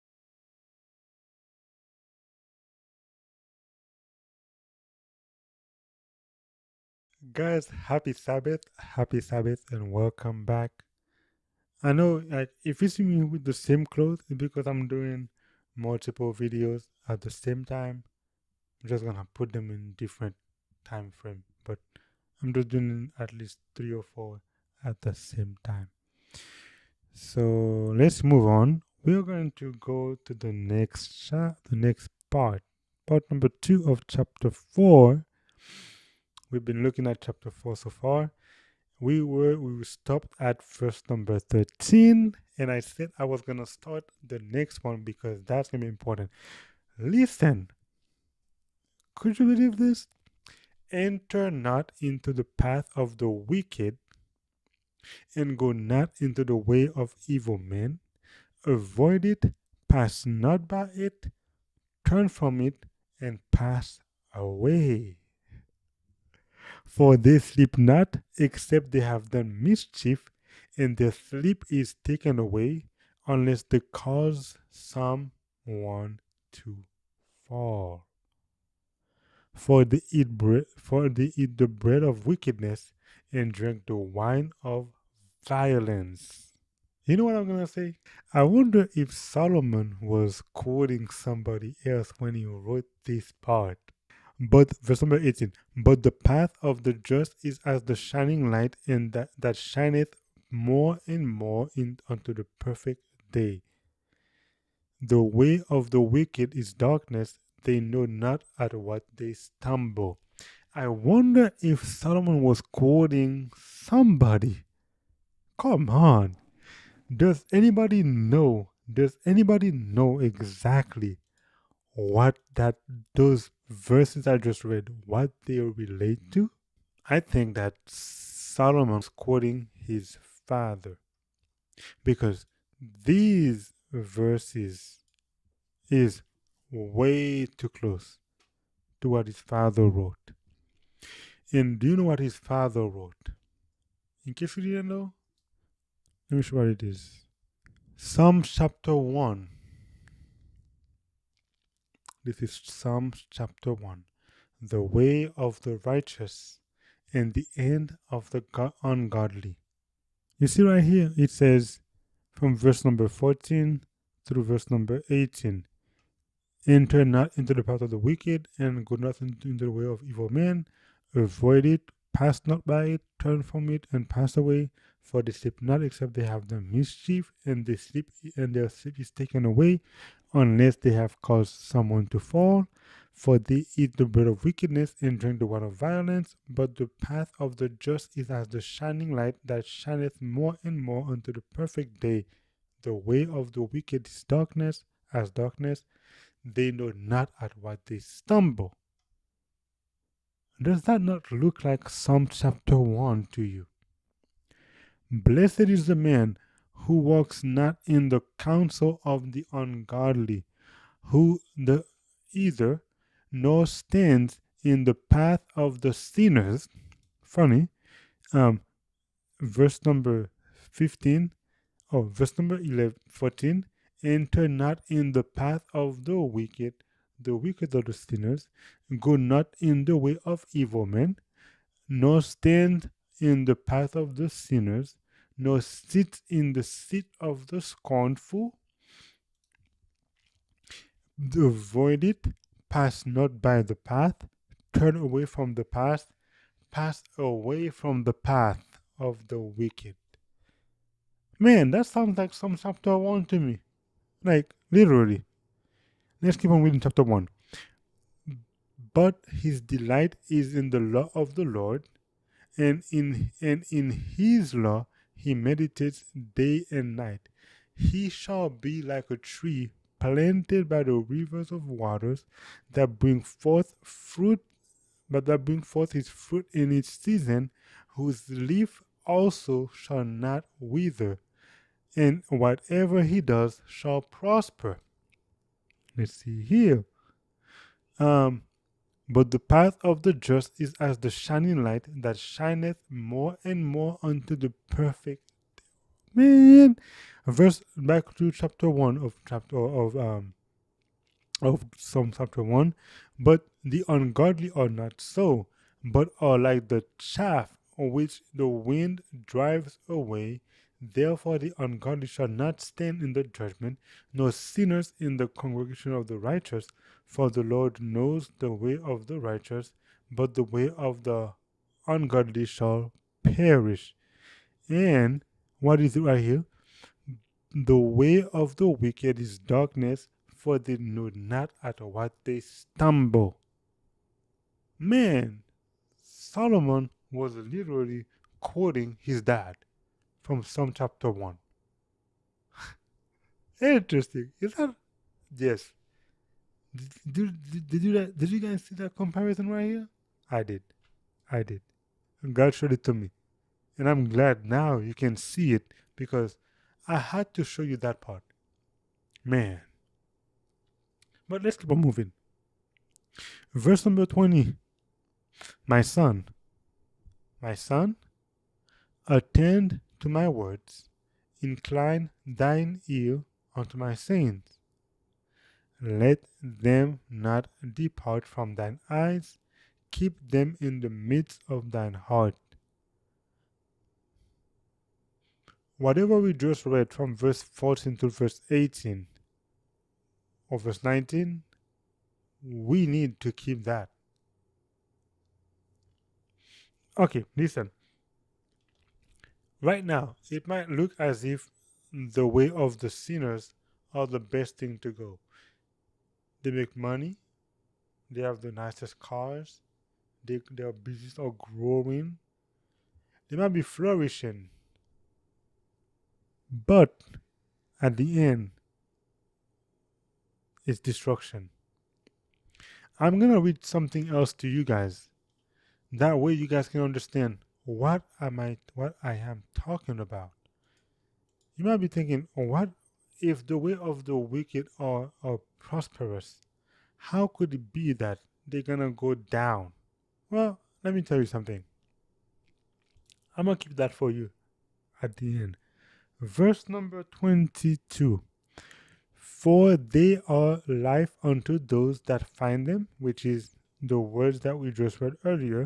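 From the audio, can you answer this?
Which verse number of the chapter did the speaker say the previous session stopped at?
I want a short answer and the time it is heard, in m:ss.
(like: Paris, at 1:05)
13, at 0:41.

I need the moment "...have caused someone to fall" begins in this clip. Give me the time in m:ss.
3:00.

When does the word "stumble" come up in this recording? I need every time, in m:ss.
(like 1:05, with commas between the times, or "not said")
1:49, 3:17, 5:32.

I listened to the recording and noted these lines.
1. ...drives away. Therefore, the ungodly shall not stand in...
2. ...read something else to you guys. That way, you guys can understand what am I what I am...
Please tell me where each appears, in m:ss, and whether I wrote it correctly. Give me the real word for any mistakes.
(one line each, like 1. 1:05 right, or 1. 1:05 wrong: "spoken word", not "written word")
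1. 5:09 right
2. 7:03 right.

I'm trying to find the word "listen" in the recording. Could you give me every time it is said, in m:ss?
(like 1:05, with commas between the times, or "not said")
0:46, 6:37.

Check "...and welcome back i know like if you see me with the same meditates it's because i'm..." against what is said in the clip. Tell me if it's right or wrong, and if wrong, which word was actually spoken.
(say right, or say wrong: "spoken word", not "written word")
wrong: "clothes", not "meditates".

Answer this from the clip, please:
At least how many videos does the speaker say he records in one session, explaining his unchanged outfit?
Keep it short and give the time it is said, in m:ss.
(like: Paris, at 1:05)
3 or 4, at 0:23.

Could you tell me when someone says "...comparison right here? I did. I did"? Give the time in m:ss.
5:48.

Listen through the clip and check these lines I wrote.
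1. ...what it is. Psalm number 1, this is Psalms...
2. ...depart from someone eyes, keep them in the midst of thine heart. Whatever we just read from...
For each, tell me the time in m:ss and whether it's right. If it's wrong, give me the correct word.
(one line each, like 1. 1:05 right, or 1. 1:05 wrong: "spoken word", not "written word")
1. 2:26 wrong: "chapter", not "number"
2. 6:17 wrong: "thine", not "someone".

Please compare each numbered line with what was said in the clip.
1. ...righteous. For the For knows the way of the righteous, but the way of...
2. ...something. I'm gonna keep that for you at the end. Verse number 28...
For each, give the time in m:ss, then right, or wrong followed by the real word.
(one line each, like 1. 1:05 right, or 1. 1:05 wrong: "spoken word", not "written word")
1. 5:16 wrong: "Lord", not "For"
2. 7:21 wrong: "22", not "28".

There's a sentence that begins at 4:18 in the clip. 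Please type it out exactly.
But his delight is in the law of the Lord, and in, and in his law he meditates day and night.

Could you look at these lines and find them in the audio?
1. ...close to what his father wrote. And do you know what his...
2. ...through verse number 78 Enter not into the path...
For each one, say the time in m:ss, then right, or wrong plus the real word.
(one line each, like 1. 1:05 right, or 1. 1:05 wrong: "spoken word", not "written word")
1. 2:17 right
2. 2:44 wrong: "18", not "78".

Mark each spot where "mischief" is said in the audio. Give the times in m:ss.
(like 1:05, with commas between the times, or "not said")
1:09, 2:56.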